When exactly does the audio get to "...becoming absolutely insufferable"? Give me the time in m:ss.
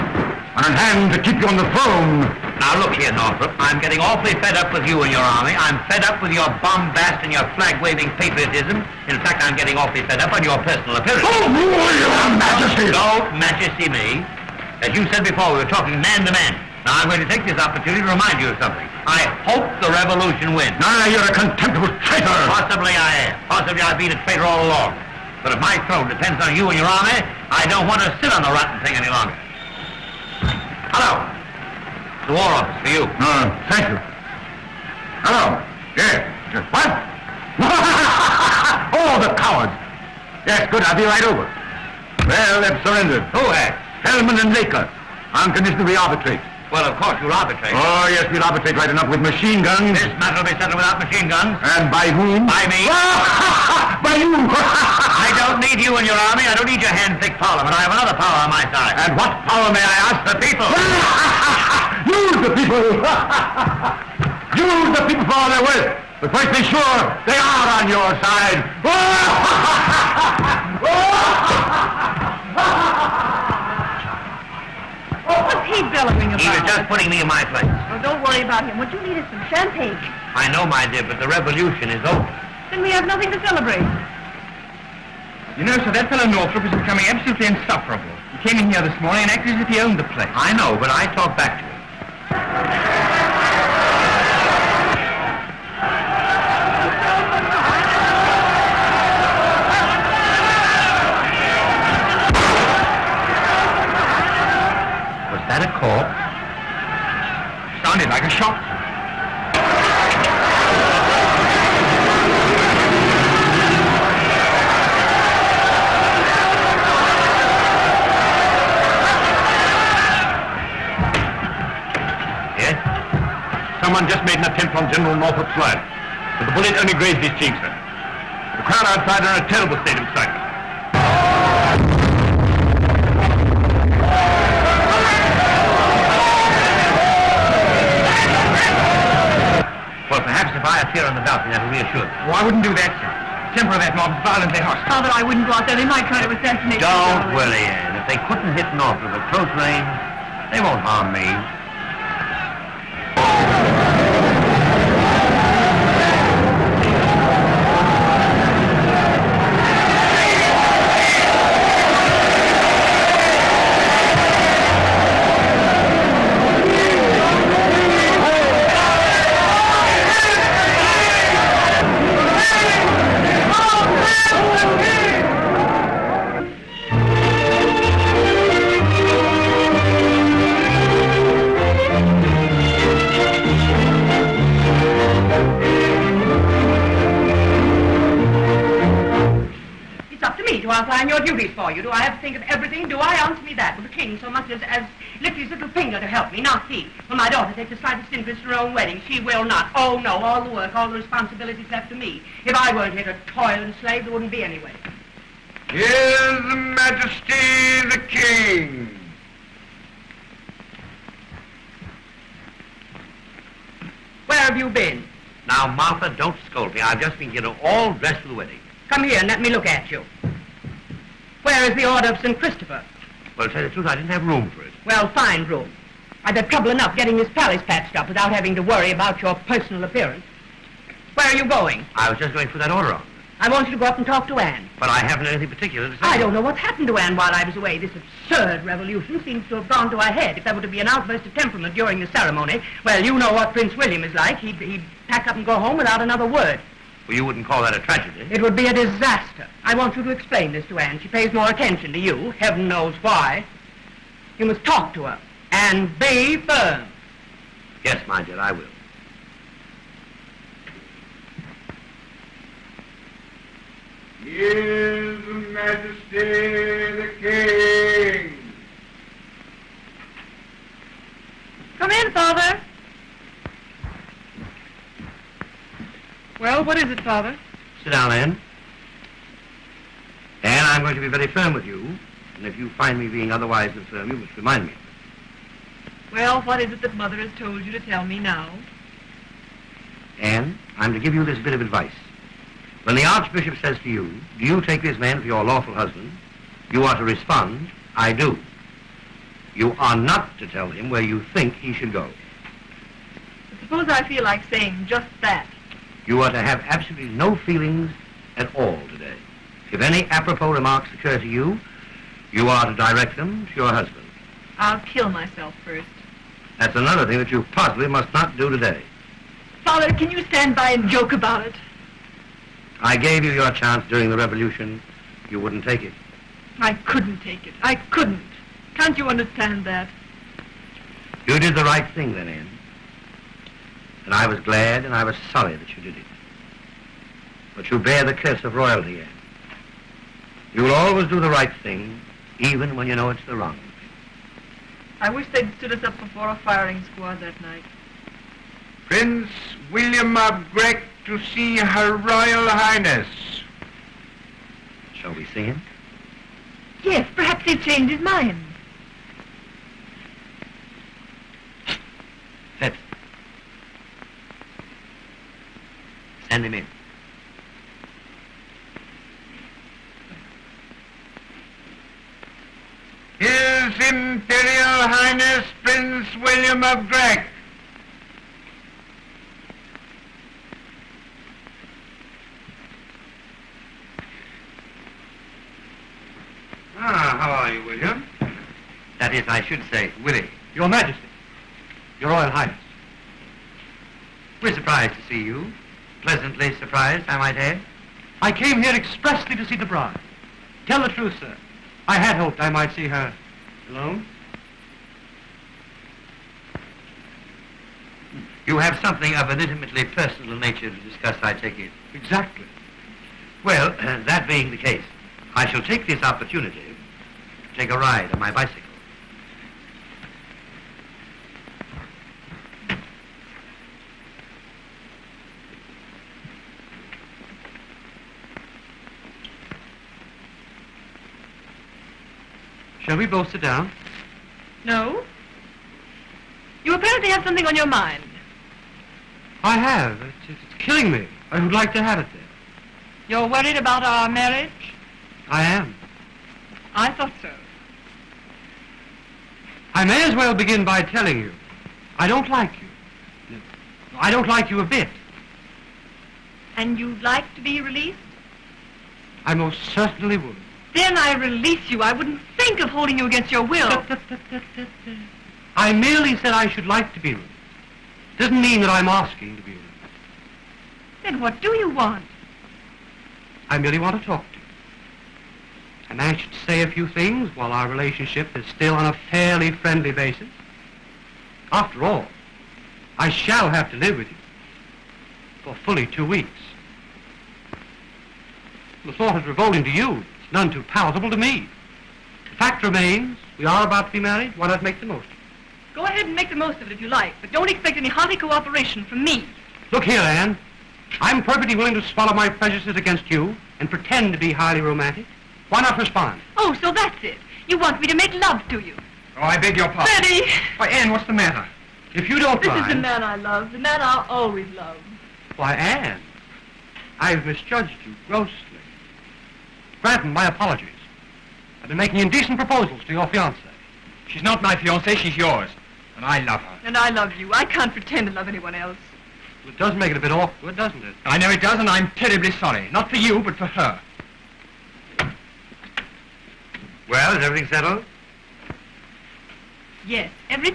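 1:26.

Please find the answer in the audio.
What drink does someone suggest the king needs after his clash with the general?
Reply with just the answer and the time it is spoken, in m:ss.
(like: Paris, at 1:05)
Champagne, at 1:19.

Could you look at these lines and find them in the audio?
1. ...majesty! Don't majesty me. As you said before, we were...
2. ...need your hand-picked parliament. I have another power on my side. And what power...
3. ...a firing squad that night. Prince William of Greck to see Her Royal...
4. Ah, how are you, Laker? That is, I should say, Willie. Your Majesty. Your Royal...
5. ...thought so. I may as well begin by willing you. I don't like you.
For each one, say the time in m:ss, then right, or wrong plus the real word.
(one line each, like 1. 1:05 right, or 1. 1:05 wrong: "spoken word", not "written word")
1. 0:12 right
2. 0:56 right
3. 5:46 right
4. 6:26 wrong: "William", not "Laker"
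5. 7:26 wrong: "telling", not "willing".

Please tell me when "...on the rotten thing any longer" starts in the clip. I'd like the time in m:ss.
0:28.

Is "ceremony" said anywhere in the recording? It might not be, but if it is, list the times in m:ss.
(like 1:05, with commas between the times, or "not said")
4:02.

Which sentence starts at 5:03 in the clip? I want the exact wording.
But suppose I feel like saying just that.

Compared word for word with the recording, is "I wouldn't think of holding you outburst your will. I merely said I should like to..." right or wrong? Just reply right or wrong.
wrong.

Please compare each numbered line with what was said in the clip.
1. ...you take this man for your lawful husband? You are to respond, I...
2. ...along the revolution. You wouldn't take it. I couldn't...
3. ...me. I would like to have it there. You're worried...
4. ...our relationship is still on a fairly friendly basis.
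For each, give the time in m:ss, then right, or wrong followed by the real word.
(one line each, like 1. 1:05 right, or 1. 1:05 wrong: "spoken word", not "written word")
1. 4:54 right
2. 5:23 wrong: "during", not "along"
3. 7:20 right
4. 7:57 right.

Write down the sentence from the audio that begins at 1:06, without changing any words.
But first be sure they are on your side.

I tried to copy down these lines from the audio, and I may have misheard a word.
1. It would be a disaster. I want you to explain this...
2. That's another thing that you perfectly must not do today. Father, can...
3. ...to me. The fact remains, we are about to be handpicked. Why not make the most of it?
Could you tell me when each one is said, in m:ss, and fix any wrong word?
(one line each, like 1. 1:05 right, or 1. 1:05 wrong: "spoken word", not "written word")
1. 4:08 right
2. 5:16 wrong: "possibly", not "perfectly"
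3. 8:11 wrong: "married", not "handpicked".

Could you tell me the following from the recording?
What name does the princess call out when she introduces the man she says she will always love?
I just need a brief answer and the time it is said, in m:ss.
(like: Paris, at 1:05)
Betty, at 8:29.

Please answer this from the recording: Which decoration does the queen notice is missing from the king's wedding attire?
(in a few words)
Order of St. Christopher.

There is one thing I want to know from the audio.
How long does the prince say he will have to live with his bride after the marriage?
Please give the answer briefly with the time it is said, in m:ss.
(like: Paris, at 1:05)
2 weeks, at 8:05.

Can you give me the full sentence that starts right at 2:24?
Father, I wouldn't go out there.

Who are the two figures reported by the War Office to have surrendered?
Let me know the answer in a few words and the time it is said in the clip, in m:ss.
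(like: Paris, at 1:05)
Fellman and Laker, at 0:44.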